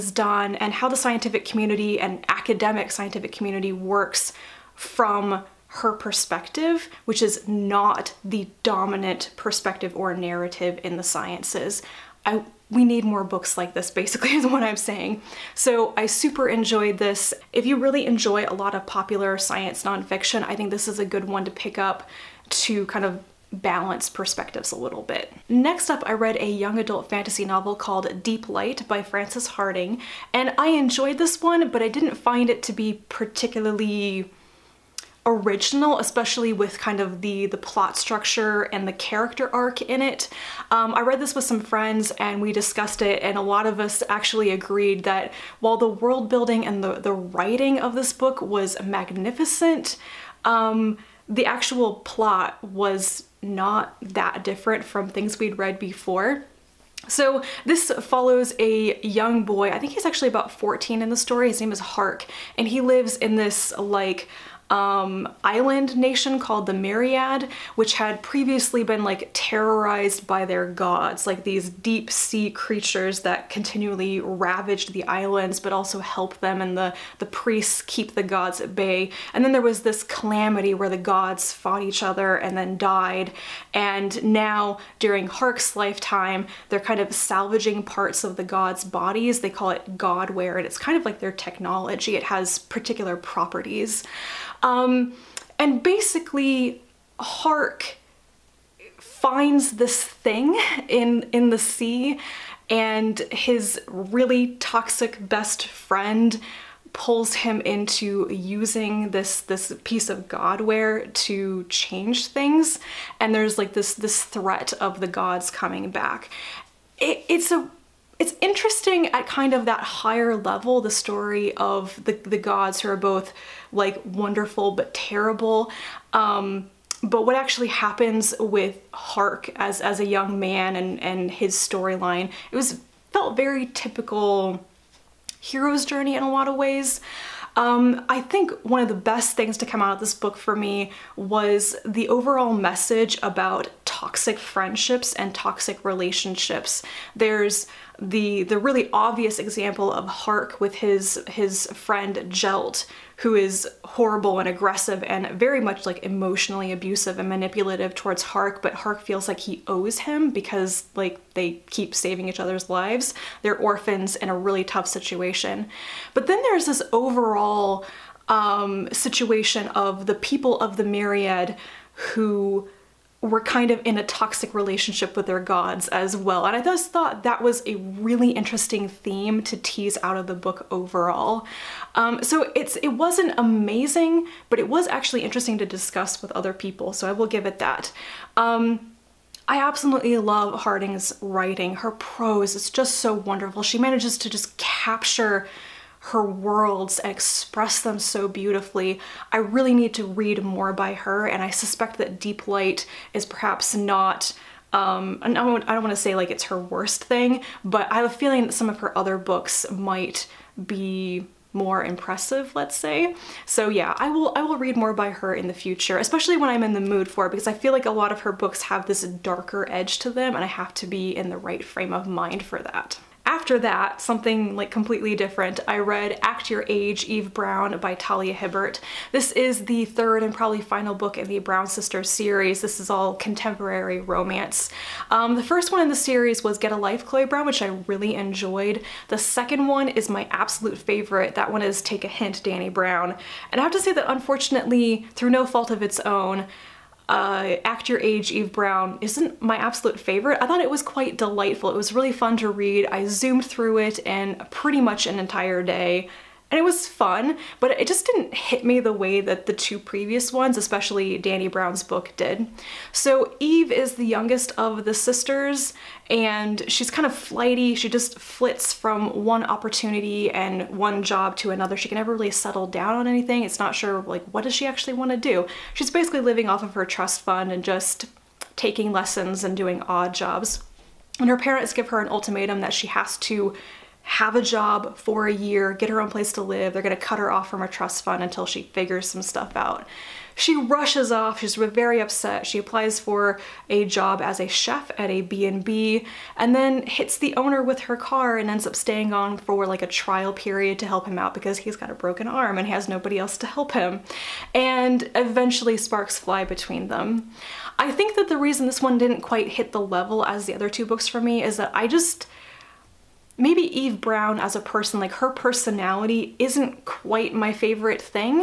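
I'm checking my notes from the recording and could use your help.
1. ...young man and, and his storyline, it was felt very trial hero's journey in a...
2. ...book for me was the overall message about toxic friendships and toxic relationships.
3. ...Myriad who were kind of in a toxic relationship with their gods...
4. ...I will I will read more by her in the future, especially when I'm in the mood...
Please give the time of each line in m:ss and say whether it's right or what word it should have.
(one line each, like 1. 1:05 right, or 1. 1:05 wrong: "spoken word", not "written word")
1. 2:10 wrong: "typical", not "trial"
2. 2:20 right
3. 2:50 right
4. 3:33 right.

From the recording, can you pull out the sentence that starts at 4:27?
She just flits from one opportunity and one job to another.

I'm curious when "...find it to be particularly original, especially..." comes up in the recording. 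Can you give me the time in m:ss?
0:32.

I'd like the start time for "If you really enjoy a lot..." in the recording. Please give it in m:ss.
0:17.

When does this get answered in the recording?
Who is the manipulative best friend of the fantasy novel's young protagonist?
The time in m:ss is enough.
2:32.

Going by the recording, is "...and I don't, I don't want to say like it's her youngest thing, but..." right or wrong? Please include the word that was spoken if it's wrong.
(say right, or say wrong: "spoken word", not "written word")
wrong: "worst", not "youngest".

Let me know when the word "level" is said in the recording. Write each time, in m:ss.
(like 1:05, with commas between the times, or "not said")
2:00, 5:09.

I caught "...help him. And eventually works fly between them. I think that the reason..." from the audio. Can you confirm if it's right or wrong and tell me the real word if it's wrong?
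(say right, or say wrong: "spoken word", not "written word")
wrong: "sparks", not "works".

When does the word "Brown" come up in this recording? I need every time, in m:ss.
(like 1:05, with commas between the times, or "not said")
3:47, 3:51, 3:57, 4:02, 4:08, 4:21, 5:14.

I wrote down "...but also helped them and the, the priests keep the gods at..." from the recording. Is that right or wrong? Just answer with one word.
right.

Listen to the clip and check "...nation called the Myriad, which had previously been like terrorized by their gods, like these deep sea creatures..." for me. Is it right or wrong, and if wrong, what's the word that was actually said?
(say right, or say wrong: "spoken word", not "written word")
right.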